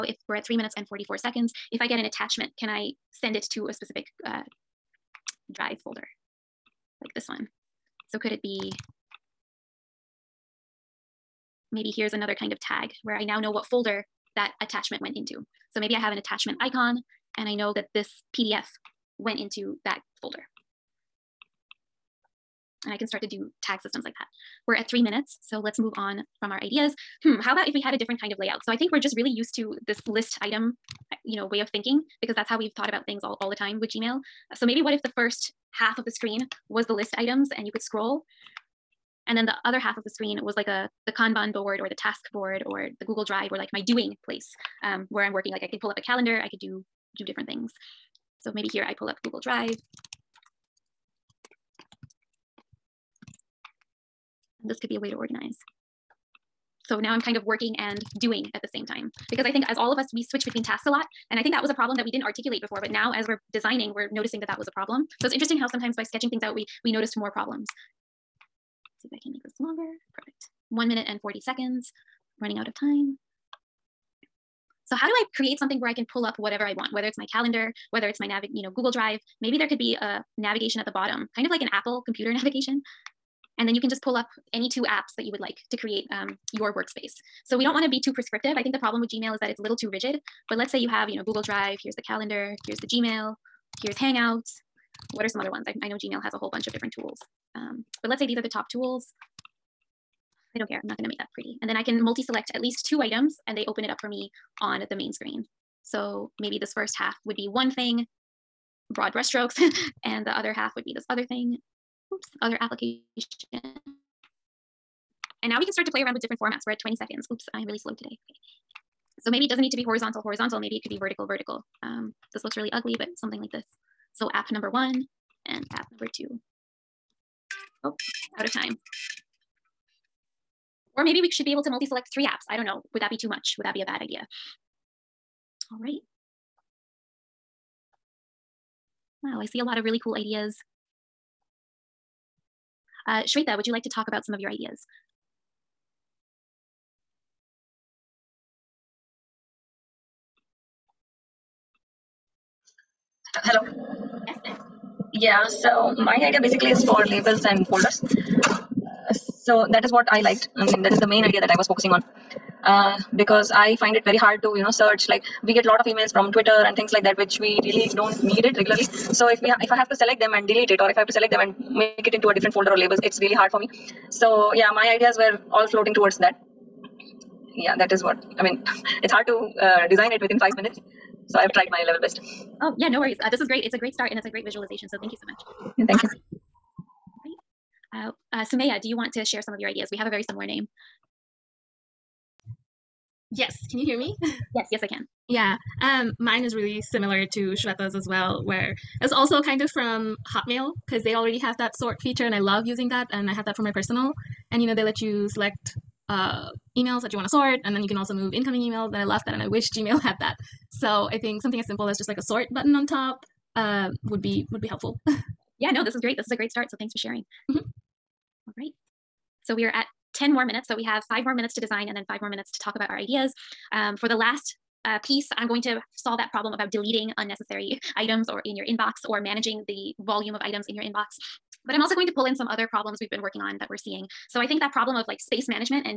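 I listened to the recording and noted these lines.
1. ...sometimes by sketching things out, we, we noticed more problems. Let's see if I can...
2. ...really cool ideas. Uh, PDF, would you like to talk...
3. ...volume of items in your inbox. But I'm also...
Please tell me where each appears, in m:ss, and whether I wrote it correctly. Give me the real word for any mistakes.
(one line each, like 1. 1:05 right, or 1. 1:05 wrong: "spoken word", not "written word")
1. 1:05 right
2. 2:19 wrong: "Shweta", not "PDF"
3. 3:49 right.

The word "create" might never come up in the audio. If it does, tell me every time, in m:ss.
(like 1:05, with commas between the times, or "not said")
1:15, 1:25.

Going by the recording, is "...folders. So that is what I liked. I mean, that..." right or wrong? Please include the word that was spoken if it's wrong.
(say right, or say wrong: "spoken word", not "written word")
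right.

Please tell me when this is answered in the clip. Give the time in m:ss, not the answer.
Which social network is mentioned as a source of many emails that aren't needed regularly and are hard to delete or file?
2:46.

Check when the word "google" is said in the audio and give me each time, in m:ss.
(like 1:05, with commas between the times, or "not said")
0:43, 0:49, 1:18, 1:31.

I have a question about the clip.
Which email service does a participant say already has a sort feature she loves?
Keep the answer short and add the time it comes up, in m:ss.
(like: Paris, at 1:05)
Hotmail, at 3:20.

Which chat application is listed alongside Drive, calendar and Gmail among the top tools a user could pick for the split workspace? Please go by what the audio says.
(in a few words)
Hangouts.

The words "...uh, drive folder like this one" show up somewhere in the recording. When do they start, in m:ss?
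0:04.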